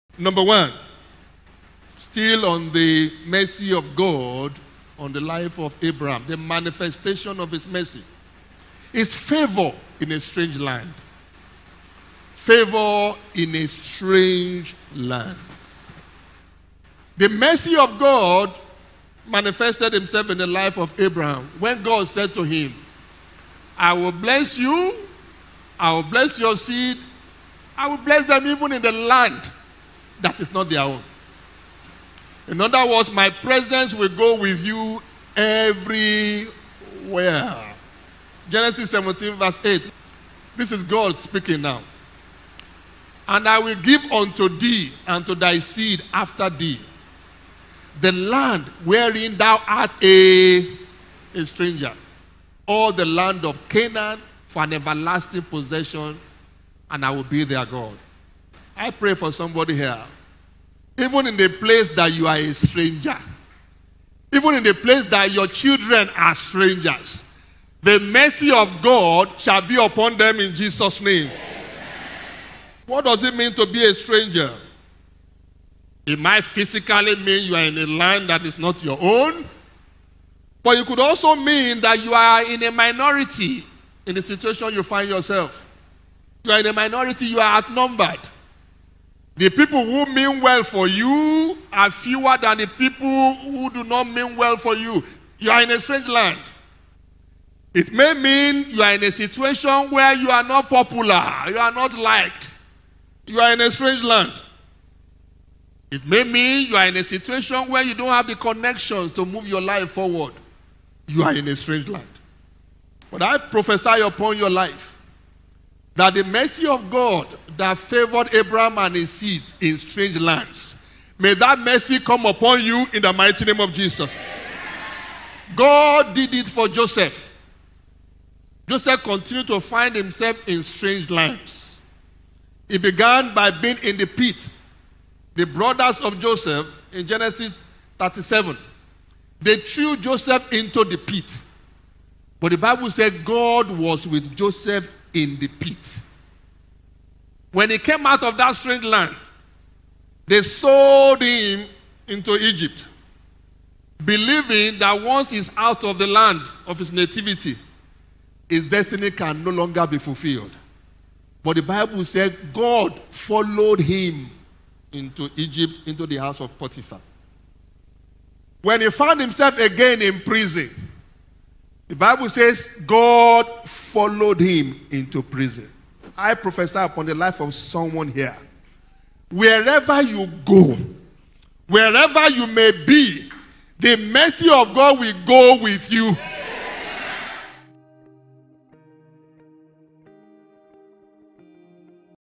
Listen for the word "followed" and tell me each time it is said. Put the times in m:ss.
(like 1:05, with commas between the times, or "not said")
2:43, 2:53.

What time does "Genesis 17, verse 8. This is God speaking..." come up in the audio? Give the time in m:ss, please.
0:38.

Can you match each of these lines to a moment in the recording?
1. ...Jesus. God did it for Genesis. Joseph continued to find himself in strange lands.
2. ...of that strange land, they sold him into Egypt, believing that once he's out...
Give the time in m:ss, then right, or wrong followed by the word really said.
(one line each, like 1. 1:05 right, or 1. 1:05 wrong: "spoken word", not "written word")
1. 2:03 wrong: "Joseph", not "Genesis"
2. 2:28 right.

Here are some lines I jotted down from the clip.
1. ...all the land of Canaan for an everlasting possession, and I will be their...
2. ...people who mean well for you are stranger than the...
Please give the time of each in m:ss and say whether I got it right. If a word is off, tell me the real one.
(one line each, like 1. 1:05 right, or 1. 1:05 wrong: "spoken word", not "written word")
1. 0:52 right
2. 1:29 wrong: "fewer", not "stranger".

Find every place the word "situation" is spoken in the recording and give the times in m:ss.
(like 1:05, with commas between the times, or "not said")
1:24, 1:39, 1:47.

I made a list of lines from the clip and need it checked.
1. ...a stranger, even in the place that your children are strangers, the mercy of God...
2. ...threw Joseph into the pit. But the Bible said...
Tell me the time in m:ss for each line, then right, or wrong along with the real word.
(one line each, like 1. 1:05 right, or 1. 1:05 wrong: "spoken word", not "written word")
1. 1:02 right
2. 2:19 right.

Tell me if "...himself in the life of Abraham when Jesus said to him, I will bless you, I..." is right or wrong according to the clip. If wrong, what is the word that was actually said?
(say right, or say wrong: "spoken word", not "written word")
wrong: "God", not "Jesus".